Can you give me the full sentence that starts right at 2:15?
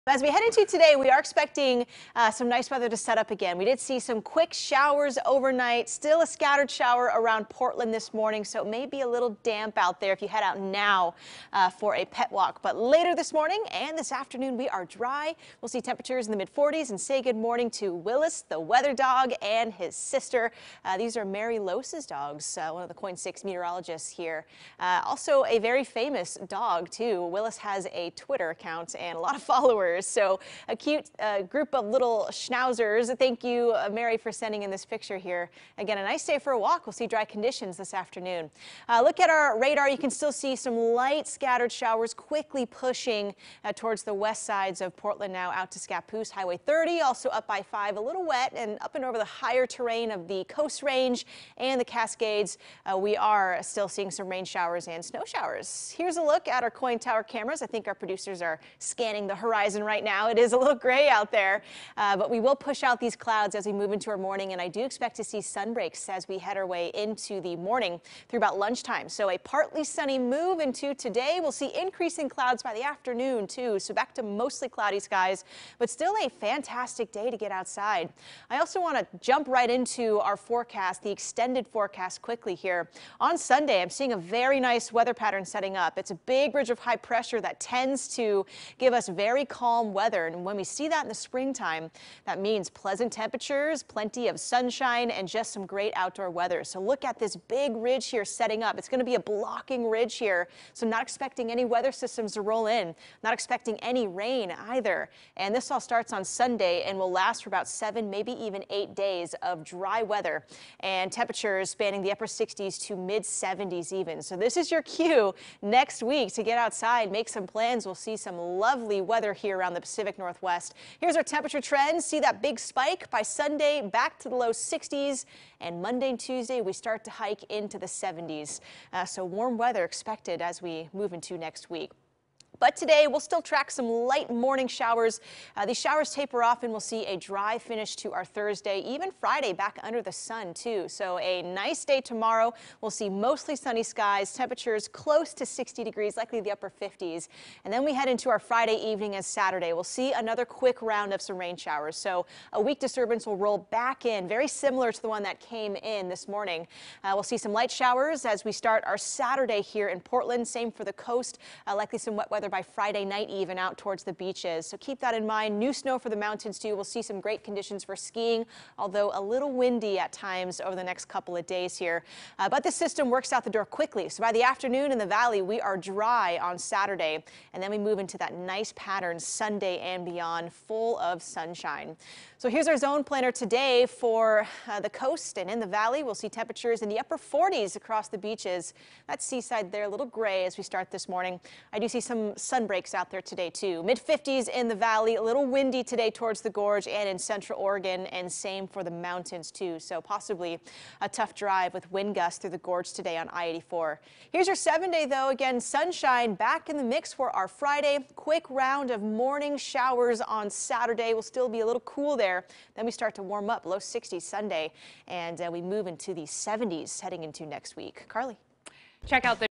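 Uh, these showers taper off and we'll see a dry finish to our Thursday, even Friday back under the sun too.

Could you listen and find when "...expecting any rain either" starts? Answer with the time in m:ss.
1:43.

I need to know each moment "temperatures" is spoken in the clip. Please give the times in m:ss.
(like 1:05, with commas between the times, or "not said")
0:15, 1:33, 1:51, 2:01, 2:24, 3:06.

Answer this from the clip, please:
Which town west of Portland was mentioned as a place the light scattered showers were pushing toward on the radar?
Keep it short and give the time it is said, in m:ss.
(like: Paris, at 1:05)
Scappoose, at 0:45.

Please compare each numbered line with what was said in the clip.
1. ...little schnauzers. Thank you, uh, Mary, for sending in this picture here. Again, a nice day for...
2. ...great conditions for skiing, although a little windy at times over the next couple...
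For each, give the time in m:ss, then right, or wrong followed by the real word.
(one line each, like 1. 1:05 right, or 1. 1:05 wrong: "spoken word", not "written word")
1. 0:31 right
2. 2:47 right.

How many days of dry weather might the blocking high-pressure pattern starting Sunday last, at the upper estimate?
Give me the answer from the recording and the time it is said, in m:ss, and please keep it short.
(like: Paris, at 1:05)
8, at 1:48.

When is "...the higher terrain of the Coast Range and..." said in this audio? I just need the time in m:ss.
0:49.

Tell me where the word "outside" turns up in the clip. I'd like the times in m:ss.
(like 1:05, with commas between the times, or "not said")
1:17, 1:56.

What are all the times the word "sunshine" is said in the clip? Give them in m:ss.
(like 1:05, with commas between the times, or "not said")
1:34, 3:01, 3:25.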